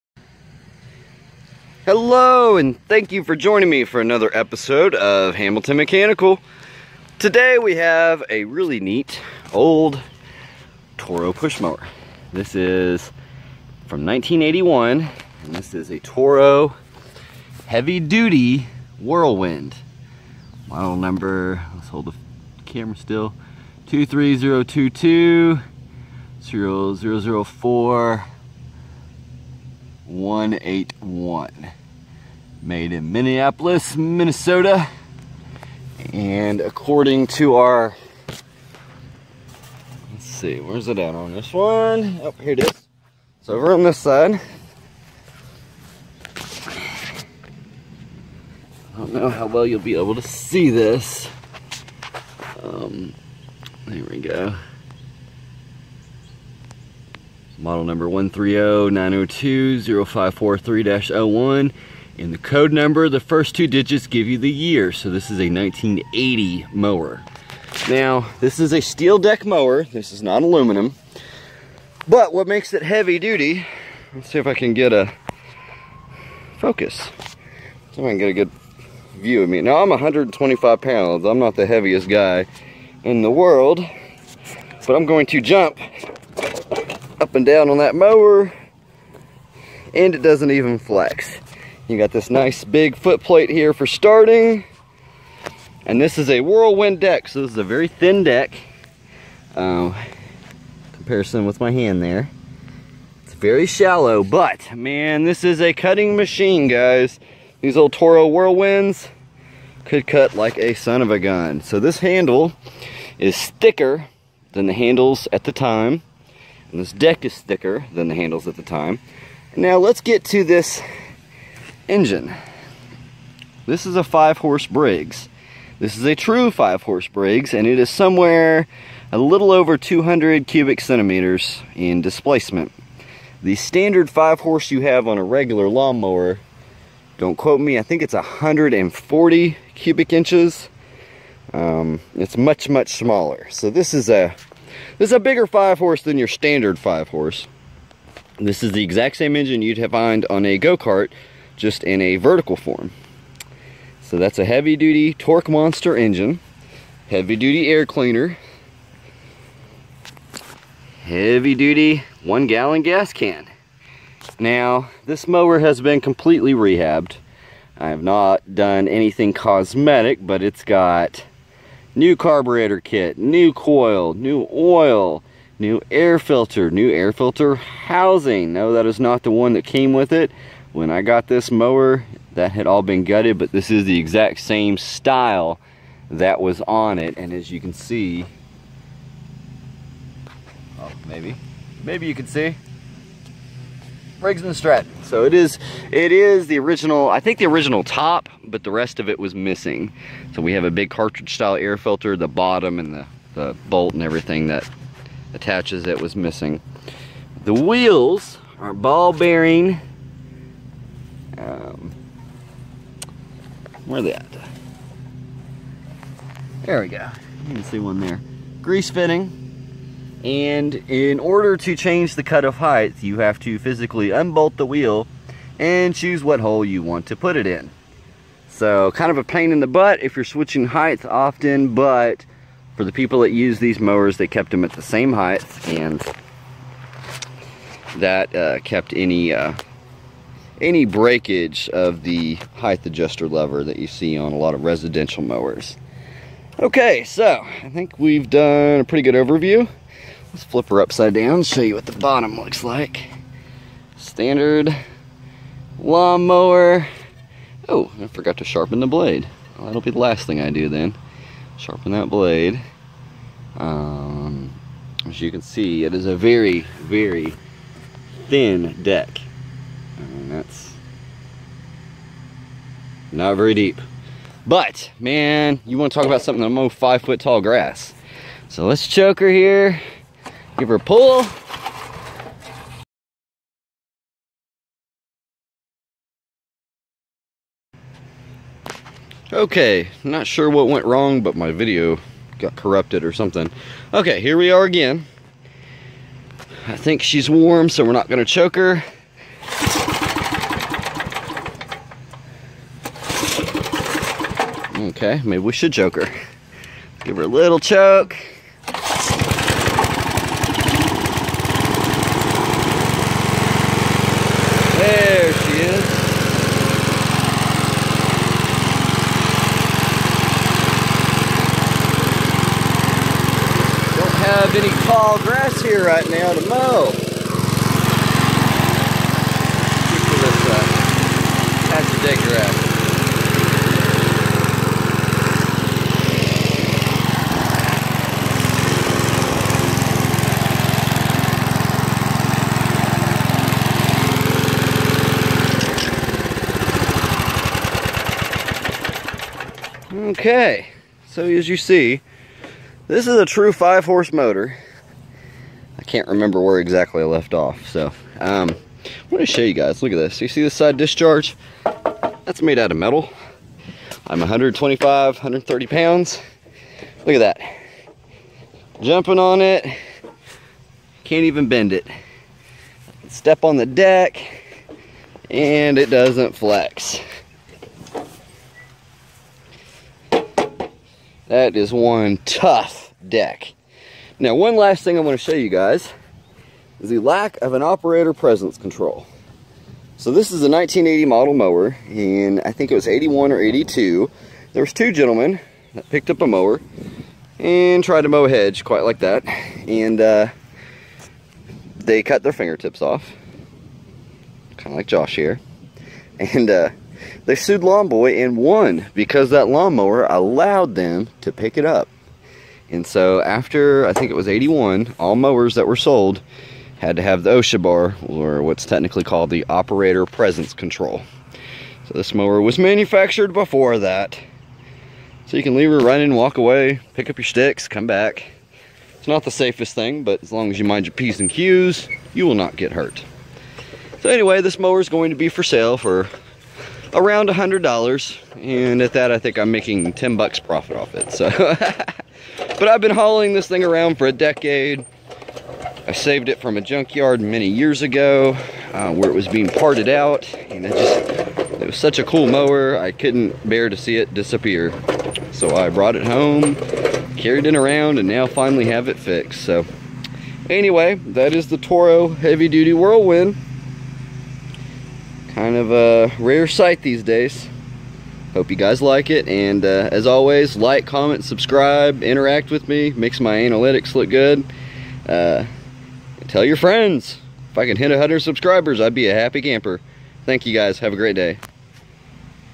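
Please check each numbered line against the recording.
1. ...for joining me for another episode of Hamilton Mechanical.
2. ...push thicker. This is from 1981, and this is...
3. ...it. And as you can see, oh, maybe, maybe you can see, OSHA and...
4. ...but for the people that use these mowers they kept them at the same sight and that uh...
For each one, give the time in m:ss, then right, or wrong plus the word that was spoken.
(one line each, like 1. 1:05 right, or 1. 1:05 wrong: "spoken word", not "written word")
1. 0:03 right
2. 0:11 wrong: "mower", not "thicker"
3. 3:06 wrong: "Briggs", not "OSHA"
4. 3:51 wrong: "height", not "sight".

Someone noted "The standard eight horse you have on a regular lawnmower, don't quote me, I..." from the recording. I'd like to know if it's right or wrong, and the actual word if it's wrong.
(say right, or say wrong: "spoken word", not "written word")
wrong: "five", not "eight".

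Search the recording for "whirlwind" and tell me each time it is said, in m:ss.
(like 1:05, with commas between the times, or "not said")
0:18, 1:36, 1:48, 7:42.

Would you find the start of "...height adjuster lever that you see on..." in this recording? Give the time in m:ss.
4:02.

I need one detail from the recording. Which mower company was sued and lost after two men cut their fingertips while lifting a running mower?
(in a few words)
Lawn Boy.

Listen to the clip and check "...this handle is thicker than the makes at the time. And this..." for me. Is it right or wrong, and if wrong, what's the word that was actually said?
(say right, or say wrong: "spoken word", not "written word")
wrong: "handles", not "makes".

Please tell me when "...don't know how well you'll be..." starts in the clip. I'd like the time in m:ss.
0:48.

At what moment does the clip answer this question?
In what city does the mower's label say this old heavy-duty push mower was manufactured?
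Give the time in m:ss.
0:33.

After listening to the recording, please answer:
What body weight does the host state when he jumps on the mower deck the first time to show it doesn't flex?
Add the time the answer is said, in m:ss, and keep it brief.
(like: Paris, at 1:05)
125 pounds, at 1:19.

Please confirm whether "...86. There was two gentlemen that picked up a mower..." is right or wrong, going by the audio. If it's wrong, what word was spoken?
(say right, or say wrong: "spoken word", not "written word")
wrong: "82", not "86".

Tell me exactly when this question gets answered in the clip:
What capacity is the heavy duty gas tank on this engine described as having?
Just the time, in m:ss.
2:42.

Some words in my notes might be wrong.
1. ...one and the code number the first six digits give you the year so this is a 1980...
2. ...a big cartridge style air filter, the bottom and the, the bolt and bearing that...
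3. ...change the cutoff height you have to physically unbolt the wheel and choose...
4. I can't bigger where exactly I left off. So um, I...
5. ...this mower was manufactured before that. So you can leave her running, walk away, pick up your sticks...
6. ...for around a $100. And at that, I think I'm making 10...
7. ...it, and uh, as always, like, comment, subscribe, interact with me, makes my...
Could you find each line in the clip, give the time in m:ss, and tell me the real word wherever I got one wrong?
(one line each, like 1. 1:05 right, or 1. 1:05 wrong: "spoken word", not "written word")
1. 1:01 wrong: "two", not "six"
2. 3:20 wrong: "everything", not "bearing"
3. 3:41 right
4. 5:55 wrong: "remember", not "bigger"
5. 7:01 right
6. 7:15 right
7. 7:49 right.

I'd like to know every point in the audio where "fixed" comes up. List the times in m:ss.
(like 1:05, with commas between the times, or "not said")
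7:38.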